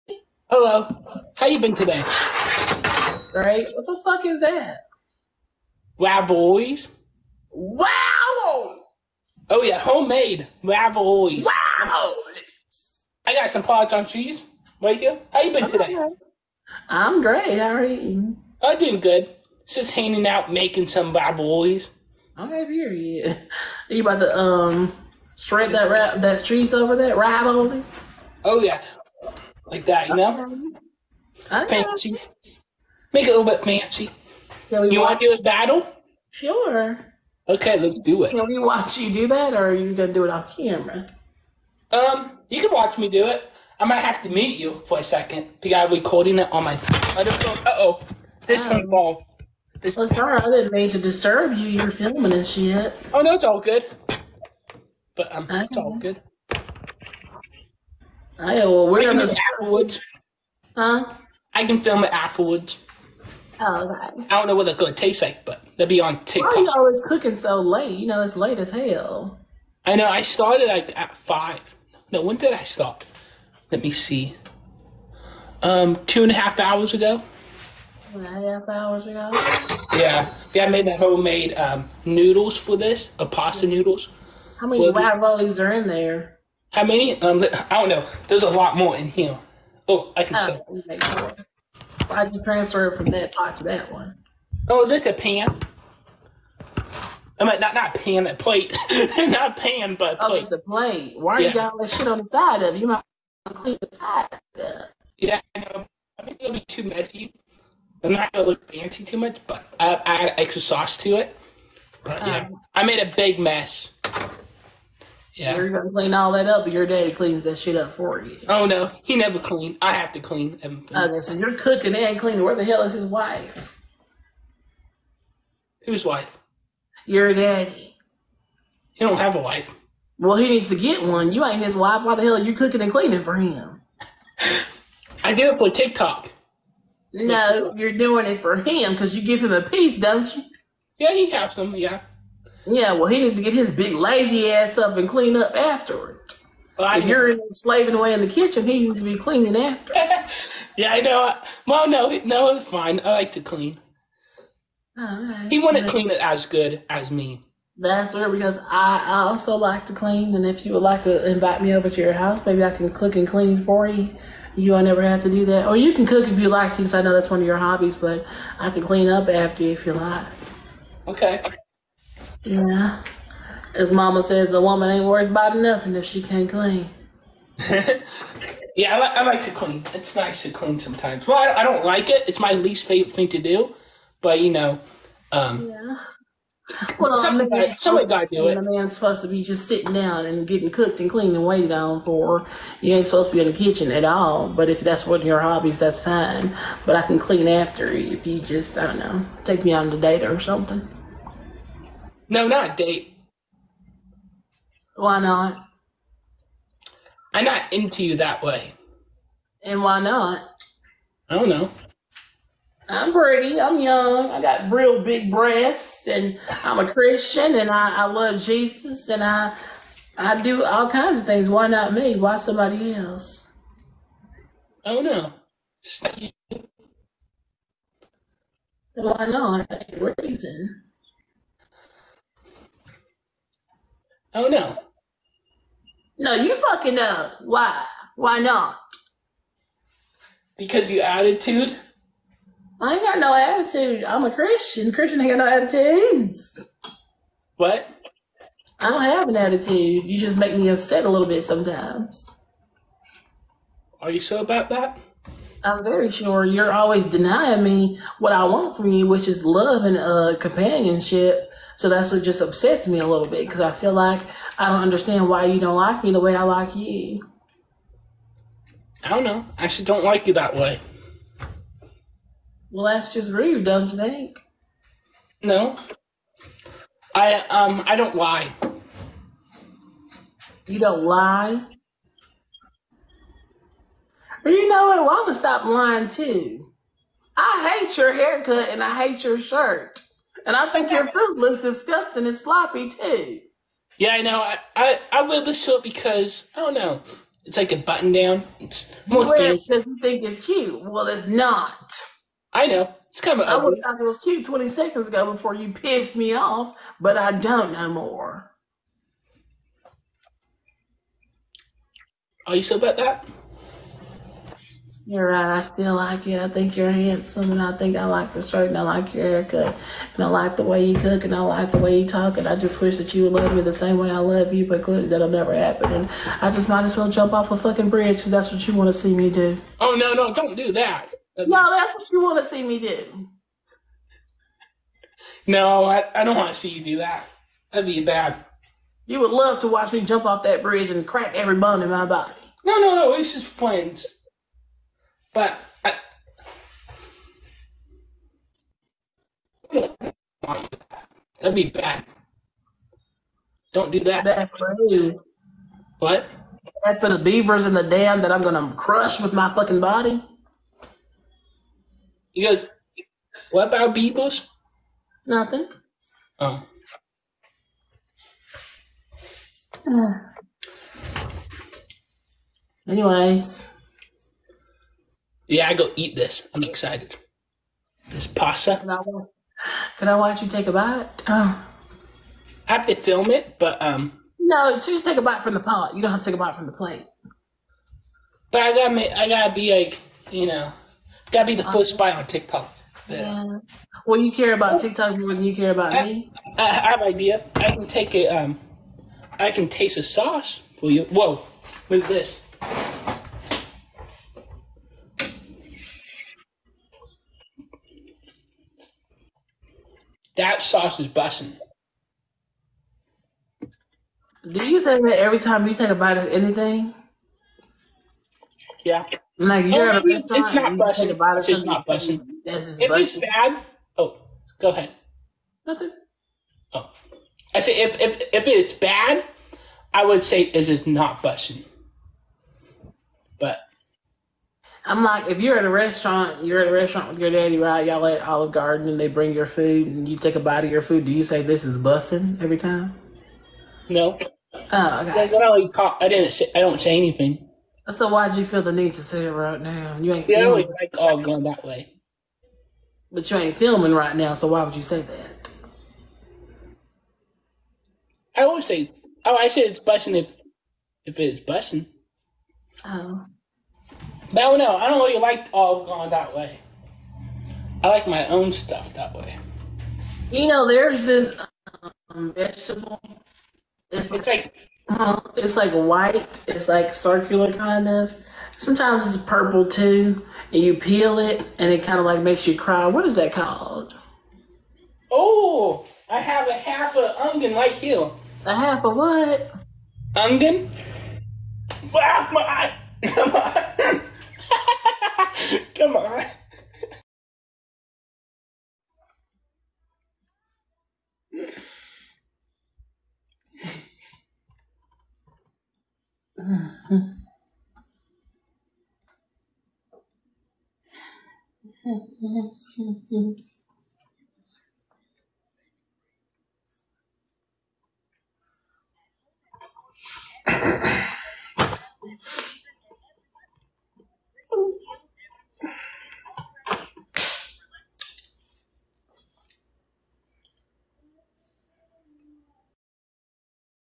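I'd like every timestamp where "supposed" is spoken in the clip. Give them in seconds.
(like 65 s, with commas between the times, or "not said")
188 s, 193 s.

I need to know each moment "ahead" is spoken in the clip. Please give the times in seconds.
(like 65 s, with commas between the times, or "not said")
424 s.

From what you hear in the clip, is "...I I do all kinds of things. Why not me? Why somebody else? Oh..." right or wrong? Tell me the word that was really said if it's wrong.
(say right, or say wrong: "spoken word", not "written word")
right.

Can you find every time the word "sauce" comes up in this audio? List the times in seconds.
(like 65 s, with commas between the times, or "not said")
110 s, 400 s, 410 s.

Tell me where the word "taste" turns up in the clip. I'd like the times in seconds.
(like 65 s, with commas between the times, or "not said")
64 s, 399 s.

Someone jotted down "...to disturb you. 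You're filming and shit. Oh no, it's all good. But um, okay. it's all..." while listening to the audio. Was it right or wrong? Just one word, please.
right.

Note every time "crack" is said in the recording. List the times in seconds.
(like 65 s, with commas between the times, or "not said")
341 s.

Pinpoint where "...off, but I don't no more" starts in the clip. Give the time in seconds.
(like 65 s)
306 s.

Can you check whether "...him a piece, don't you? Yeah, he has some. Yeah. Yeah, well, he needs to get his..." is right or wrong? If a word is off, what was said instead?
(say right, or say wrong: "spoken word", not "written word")
right.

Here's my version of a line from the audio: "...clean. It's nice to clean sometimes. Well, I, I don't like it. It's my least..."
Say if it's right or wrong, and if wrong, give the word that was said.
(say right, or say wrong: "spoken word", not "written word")
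right.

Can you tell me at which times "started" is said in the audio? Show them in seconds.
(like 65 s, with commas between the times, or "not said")
70 s.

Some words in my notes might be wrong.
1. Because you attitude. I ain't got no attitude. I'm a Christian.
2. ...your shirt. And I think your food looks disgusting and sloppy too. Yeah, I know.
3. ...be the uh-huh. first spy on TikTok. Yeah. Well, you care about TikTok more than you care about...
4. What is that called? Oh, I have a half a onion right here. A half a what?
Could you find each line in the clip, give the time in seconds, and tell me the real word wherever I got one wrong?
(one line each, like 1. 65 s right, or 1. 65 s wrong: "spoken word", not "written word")
1. 240 s right
2. 289 s right
3. 391 s right
4. 482 s right.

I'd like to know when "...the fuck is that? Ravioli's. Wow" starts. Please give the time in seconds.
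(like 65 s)
3 s.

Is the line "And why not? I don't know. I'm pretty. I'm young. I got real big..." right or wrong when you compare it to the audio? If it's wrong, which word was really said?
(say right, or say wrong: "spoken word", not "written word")
right.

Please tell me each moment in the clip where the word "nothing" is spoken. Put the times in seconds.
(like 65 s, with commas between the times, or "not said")
175 s, 365 s, 425 s.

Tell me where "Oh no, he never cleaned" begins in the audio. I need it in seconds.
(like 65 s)
118 s.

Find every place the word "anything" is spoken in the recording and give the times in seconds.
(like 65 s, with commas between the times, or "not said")
416 s, 446 s.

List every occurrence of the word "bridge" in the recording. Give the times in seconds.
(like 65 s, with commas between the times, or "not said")
327 s, 340 s.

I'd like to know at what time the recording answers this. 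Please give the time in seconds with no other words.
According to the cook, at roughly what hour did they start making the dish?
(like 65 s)
71 s.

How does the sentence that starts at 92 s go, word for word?
Why'd you transfer it from that pot to that one?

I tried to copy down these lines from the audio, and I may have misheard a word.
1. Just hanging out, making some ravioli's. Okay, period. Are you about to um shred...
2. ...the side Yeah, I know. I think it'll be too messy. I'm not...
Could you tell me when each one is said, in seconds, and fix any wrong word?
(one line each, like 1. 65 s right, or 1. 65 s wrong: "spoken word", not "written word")
1. 19 s right
2. 103 s right.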